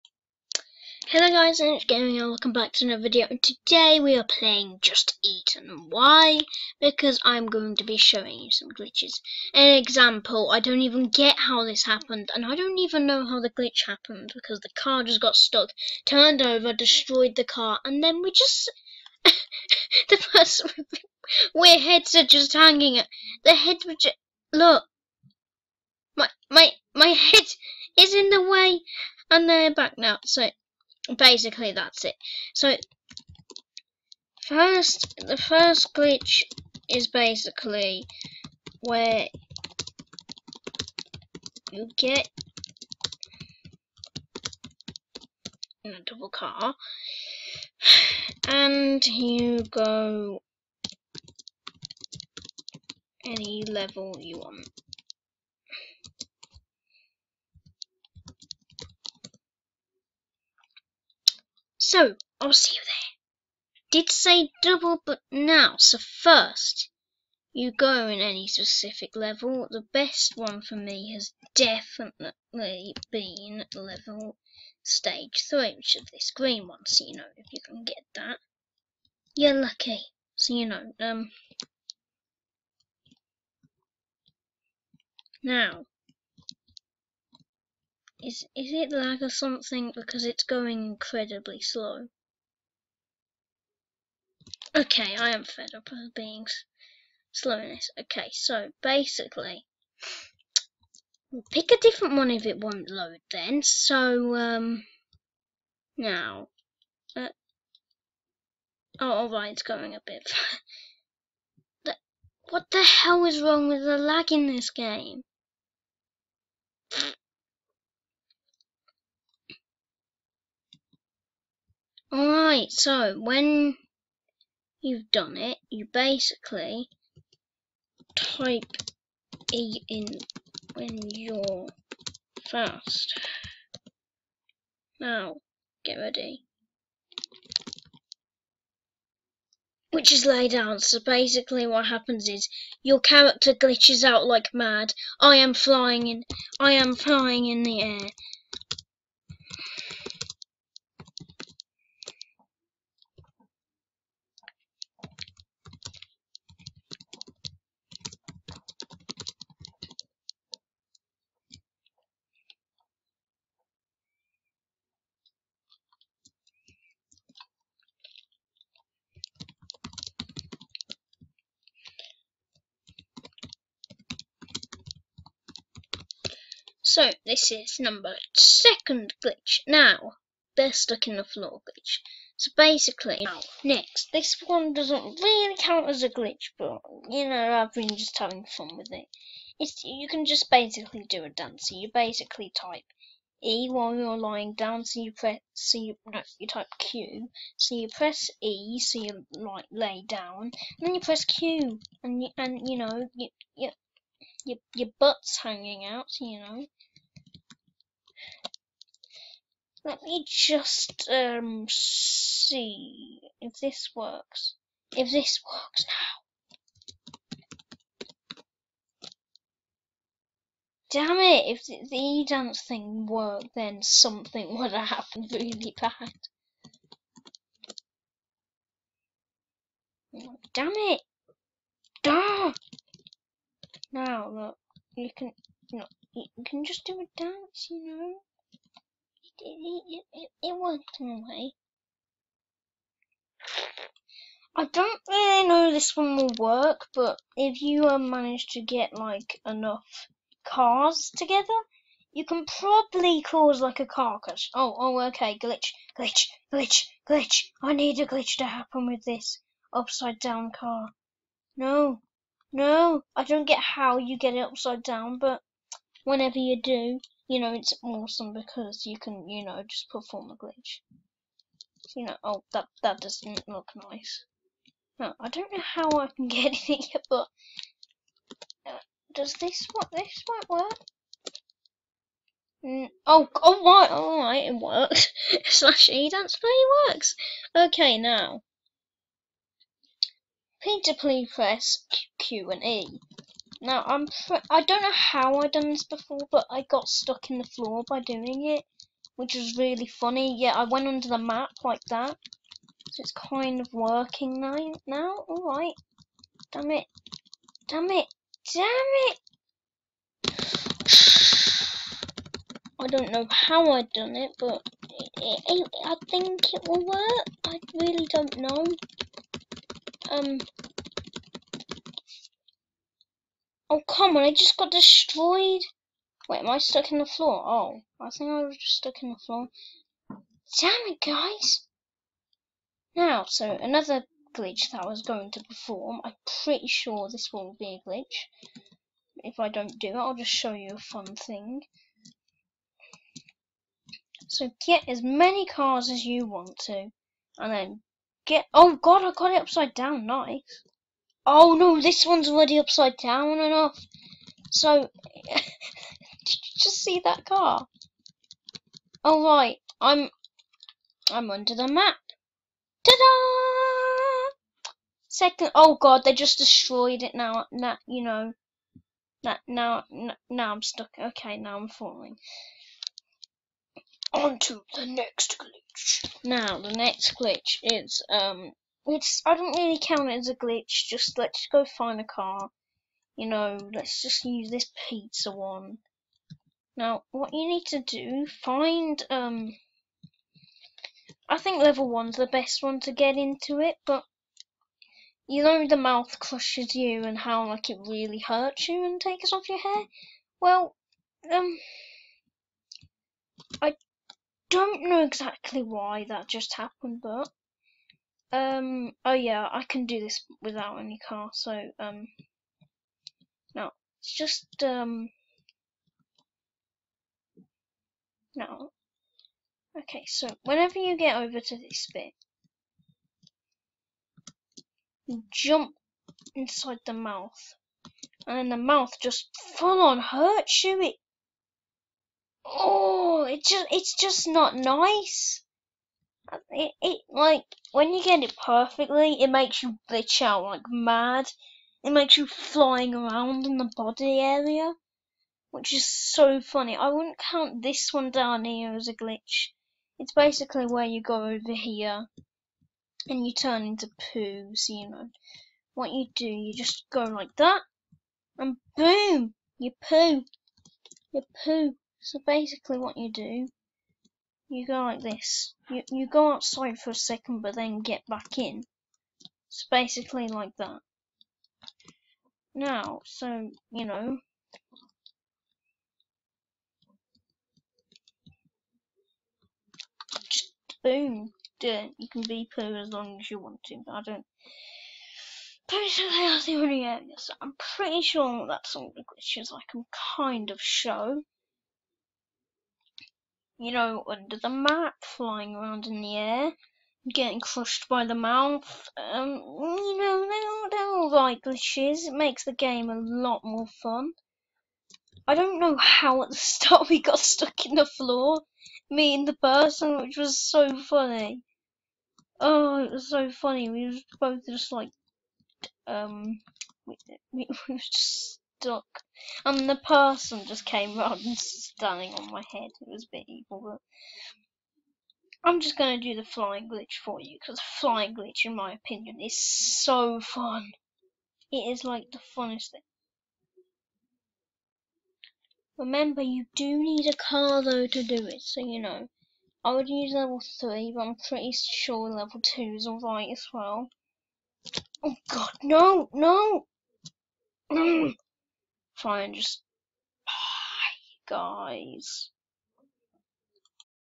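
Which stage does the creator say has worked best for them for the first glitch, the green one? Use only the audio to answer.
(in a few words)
Stage 3.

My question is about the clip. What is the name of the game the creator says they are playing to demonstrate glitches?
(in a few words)
Get Eaten.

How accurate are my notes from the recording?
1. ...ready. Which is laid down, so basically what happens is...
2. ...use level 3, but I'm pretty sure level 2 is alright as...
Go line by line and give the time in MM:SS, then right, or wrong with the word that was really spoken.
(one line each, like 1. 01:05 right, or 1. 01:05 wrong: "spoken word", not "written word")
1. 02:15 right
2. 08:59 right.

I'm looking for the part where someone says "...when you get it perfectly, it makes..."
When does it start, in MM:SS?
07:17.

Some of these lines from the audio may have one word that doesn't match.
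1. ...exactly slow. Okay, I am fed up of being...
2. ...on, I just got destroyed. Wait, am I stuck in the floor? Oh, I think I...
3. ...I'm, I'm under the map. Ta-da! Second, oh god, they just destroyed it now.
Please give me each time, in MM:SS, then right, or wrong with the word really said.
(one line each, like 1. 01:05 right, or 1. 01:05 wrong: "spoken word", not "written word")
1. 01:30 wrong: "incredibly", not "exactly"
2. 05:24 right
3. 05:59 right.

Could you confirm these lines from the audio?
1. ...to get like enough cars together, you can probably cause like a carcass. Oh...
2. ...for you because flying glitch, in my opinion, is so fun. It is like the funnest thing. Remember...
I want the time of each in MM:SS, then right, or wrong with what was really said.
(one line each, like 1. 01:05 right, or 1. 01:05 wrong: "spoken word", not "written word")
1. 04:08 right
2. 08:47 right.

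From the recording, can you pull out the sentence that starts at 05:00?
Yeah, I went under the map like that, so it's kind of working now.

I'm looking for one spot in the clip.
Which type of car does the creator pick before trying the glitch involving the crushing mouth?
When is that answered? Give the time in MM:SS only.
06:24.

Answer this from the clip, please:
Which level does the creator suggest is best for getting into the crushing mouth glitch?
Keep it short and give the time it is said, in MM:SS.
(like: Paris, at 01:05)
Level one, at 06:31.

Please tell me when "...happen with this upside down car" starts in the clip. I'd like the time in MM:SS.
04:18.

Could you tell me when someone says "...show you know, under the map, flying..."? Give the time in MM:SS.
08:10.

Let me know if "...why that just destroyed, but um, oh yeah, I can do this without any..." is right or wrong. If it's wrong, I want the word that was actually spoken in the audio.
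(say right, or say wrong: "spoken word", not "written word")
wrong: "happened", not "destroyed".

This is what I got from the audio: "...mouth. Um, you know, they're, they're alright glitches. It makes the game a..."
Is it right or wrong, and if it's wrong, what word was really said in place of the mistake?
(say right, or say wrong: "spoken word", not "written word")
right.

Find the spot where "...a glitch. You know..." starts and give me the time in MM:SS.
04:30.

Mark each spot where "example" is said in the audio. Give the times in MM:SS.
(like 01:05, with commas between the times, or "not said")
00:09.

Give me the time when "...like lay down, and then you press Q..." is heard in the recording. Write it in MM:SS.
03:19.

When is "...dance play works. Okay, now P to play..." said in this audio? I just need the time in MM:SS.
04:46.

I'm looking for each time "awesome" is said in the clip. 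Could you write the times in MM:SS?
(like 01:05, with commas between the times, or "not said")
04:27.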